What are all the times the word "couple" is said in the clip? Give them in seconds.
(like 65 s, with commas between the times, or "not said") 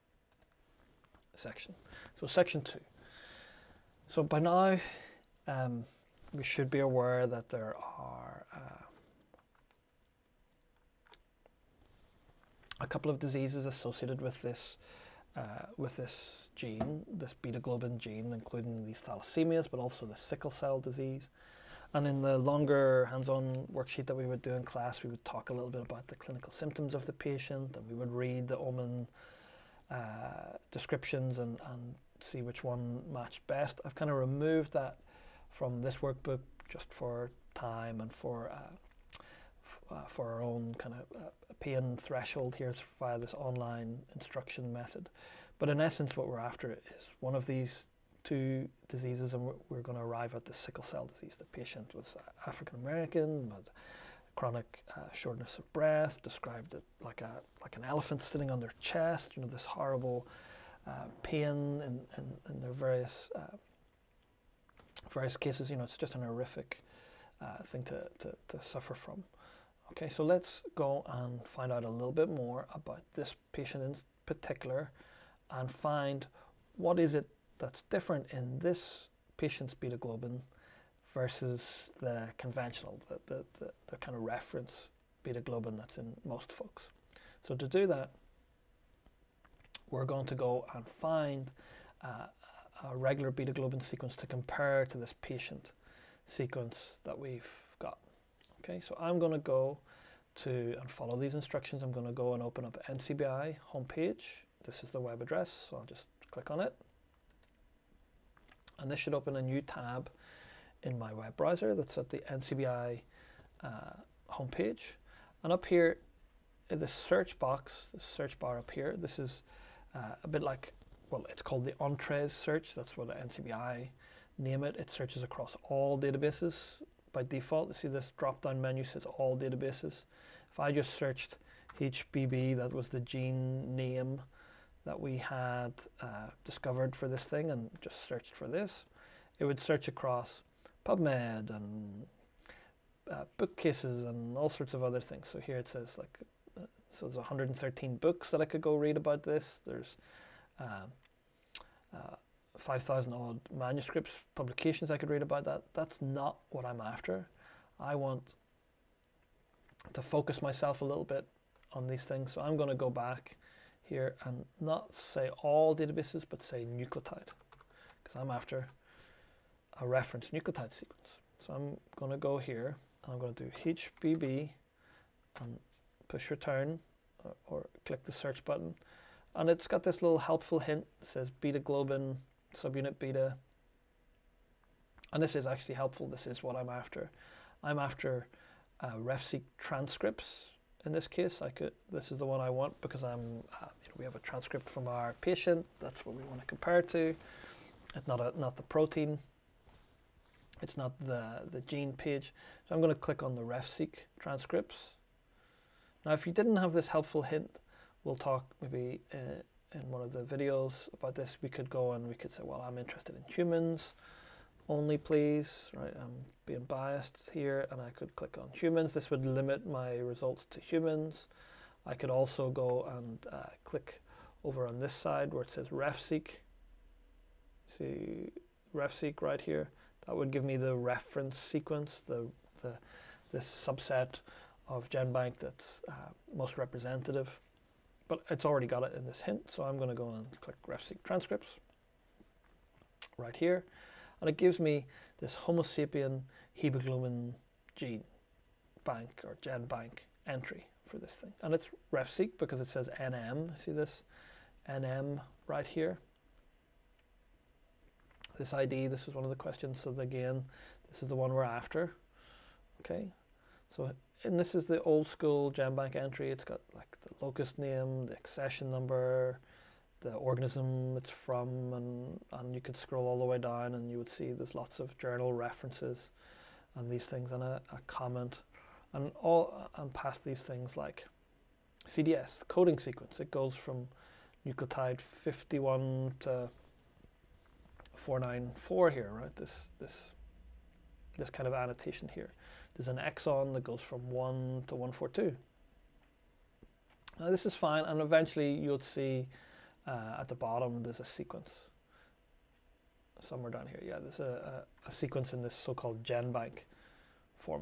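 12 s.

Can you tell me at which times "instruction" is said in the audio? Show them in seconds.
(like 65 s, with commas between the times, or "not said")
44 s, 101 s.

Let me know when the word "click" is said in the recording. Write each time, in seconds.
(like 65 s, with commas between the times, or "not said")
106 s, 177 s, 202 s, 218 s, 223 s, 240 s.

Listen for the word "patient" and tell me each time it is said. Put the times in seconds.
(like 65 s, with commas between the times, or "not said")
27 s, 51 s, 73 s, 79 s, 95 s, 195 s.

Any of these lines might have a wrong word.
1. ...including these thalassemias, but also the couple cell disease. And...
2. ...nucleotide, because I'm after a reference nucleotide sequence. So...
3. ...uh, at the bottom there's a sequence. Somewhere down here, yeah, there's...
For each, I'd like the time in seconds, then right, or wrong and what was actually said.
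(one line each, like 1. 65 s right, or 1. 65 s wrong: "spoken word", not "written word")
1. 18 s wrong: "sickle", not "couple"
2. 166 s right
3. 299 s right.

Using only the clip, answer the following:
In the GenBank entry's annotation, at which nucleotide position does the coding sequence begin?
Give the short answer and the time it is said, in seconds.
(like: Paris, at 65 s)
51, at 284 s.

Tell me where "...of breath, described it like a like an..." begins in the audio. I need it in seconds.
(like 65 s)
55 s.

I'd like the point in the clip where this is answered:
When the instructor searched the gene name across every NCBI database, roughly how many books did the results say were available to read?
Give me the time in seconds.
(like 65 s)
147 s.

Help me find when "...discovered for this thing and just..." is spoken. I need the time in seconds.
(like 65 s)
136 s.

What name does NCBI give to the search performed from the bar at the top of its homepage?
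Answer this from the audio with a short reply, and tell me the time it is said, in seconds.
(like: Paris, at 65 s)
Entrez, at 121 s.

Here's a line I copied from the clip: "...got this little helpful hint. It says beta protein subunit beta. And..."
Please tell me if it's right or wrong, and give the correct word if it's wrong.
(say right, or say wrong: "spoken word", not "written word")
wrong: "globin", not "protein".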